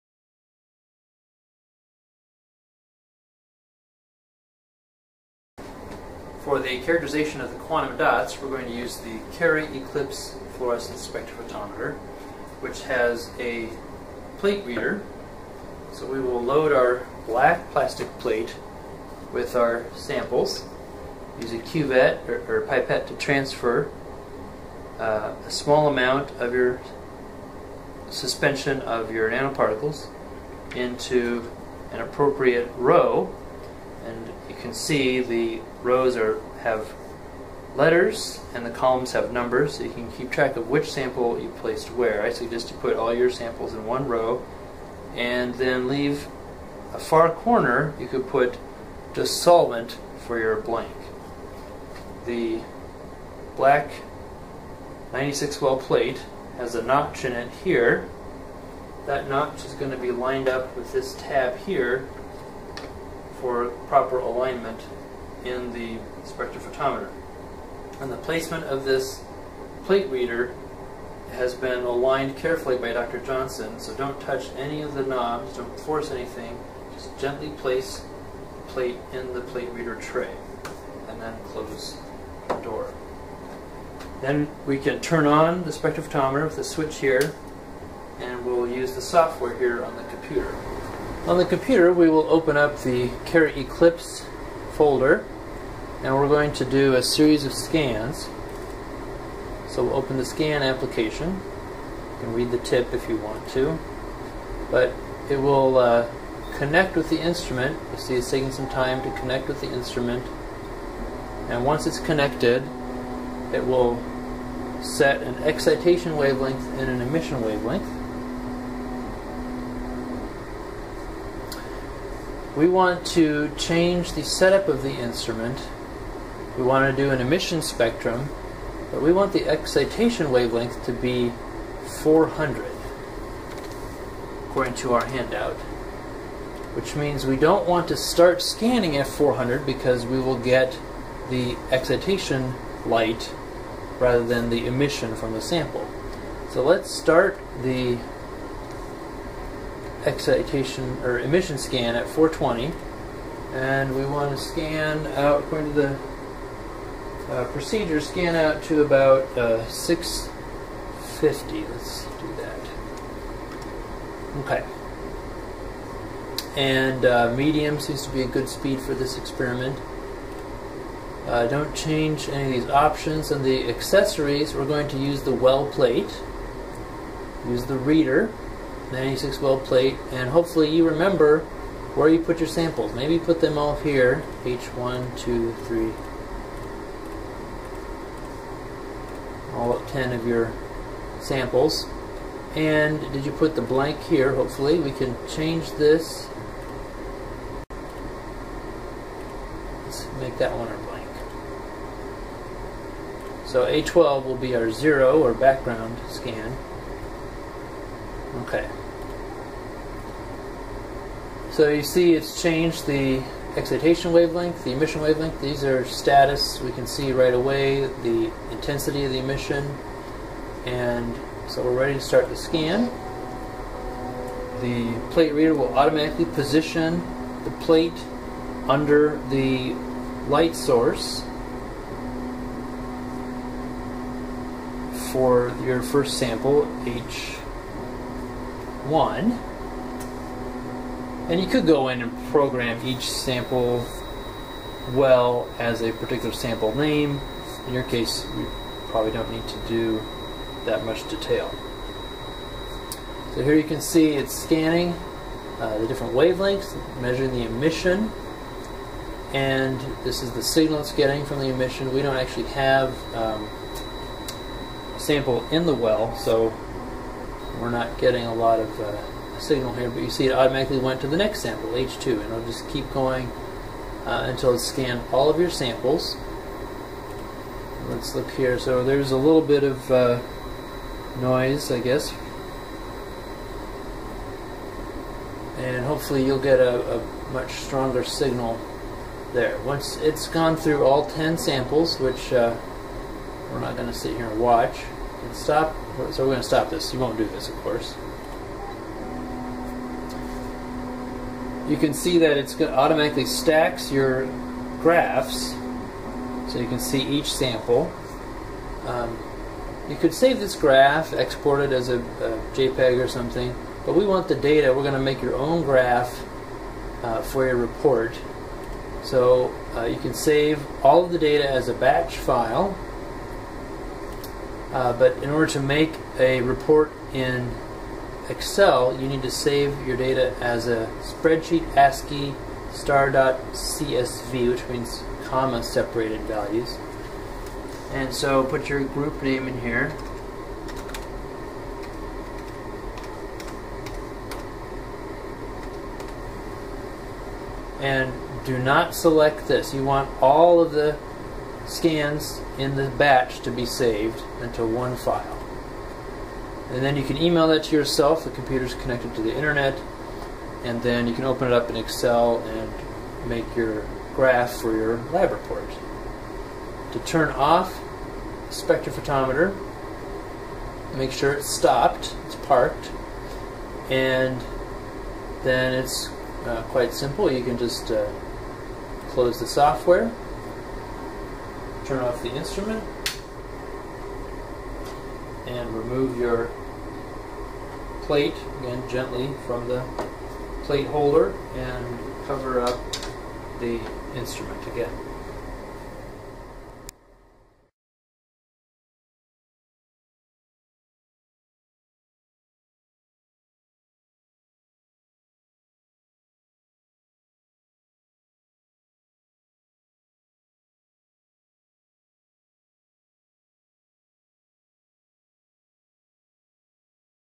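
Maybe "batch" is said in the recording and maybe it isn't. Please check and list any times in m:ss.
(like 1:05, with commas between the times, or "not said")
5:21, 5:52.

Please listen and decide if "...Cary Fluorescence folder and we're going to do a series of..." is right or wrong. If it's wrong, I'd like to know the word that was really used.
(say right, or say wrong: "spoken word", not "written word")
wrong: "Eclipse", not "Fluorescence".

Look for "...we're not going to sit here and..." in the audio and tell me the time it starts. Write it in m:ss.
4:53.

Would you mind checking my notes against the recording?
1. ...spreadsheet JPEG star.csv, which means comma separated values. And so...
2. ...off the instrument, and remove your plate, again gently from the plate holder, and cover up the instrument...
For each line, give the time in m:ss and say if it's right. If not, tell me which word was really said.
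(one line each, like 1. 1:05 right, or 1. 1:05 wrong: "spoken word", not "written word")
1. 5:31 wrong: "ASCII", not "JPEG"
2. 6:22 right.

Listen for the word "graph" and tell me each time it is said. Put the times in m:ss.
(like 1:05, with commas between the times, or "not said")
5:04, 5:10, 5:15, 6:04.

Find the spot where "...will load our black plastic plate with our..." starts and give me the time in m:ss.
0:16.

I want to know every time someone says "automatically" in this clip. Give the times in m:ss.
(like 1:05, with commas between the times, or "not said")
3:45, 4:30, 5:02.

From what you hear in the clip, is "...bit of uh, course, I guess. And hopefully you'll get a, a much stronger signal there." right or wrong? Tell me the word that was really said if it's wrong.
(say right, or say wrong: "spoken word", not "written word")
wrong: "noise", not "course".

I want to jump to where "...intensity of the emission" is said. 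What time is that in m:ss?
3:38.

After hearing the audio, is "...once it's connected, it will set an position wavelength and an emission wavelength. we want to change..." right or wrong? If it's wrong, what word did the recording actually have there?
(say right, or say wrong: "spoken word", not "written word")
wrong: "excitation", not "position".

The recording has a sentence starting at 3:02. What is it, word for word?
Maybe put them all here, H1, 2, 3, all 10 of your samples.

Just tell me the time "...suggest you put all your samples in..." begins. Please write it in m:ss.
0:42.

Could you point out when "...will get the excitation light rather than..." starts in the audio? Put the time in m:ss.
2:20.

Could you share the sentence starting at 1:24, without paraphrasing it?
Then we can turn on the spectrophotometer with the switch here, and we'll use the software here on the computer.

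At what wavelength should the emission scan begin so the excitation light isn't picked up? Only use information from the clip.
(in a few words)
420.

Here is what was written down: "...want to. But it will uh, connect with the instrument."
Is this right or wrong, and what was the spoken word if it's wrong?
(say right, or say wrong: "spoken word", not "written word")
right.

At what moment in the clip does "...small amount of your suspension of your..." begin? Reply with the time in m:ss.
0:25.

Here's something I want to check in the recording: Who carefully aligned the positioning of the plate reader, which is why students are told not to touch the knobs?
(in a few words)
Dr. Johnson.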